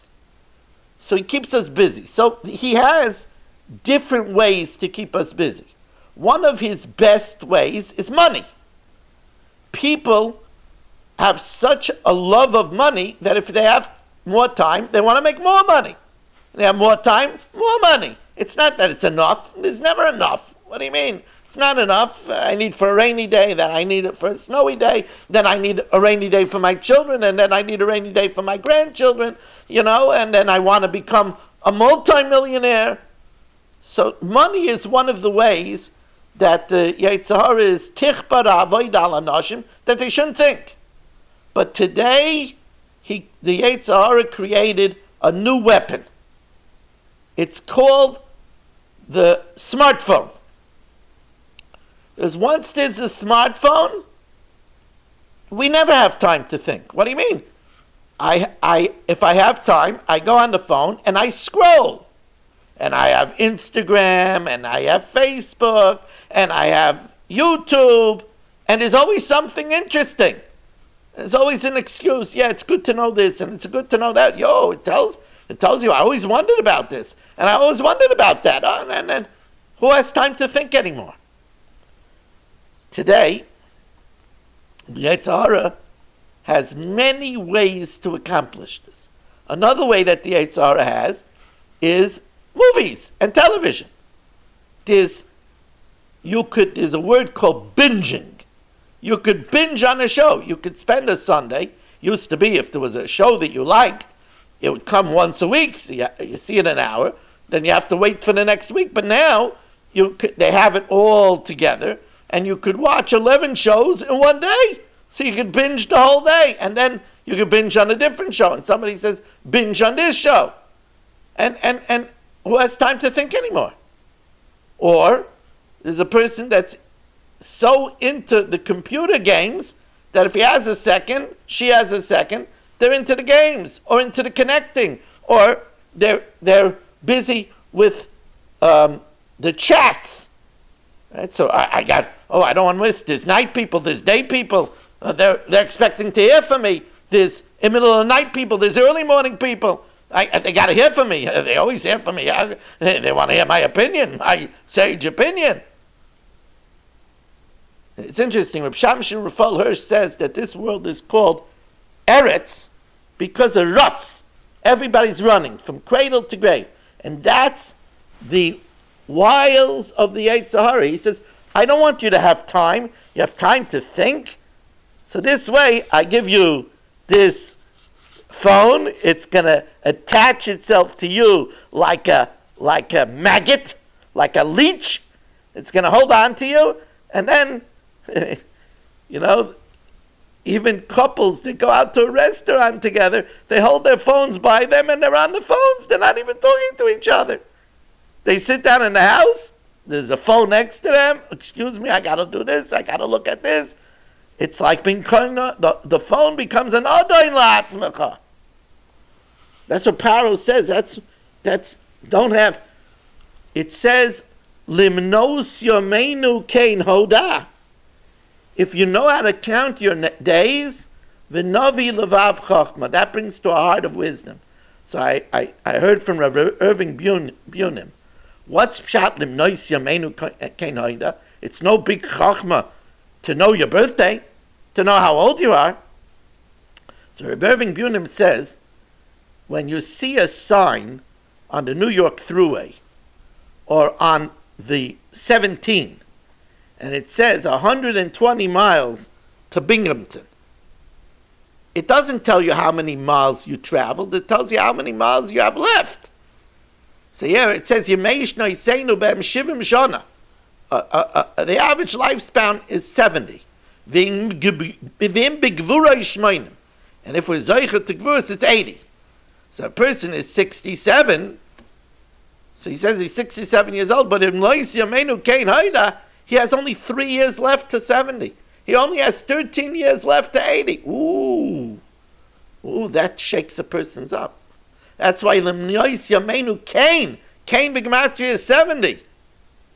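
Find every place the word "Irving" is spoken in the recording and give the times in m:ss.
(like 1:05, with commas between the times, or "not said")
3:46, 3:57.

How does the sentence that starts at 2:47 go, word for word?
And that's the wiles of the Yetzer Hara.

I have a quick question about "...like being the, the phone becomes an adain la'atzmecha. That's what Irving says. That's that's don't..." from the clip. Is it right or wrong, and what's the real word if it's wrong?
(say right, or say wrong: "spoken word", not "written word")
wrong: "Paro", not "Irving".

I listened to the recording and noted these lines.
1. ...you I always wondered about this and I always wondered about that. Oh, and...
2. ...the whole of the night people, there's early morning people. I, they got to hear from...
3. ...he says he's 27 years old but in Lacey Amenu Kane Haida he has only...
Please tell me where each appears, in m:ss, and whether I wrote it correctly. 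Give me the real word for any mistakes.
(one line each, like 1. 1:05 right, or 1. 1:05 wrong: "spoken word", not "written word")
1. 1:15 right
2. 2:27 wrong: "middle", not "whole"
3. 4:32 wrong: "67", not "27".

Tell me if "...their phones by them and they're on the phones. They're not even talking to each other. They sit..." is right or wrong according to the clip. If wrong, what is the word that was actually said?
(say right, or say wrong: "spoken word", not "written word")
right.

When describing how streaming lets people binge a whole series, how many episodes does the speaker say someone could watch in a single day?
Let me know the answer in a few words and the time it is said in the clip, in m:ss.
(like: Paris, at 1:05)
11, at 1:53.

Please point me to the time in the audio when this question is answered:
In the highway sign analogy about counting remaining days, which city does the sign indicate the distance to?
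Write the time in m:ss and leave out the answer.
4:09.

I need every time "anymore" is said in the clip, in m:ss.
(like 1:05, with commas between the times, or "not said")
1:20, 2:03.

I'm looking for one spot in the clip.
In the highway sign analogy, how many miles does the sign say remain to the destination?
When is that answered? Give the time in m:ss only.
4:07.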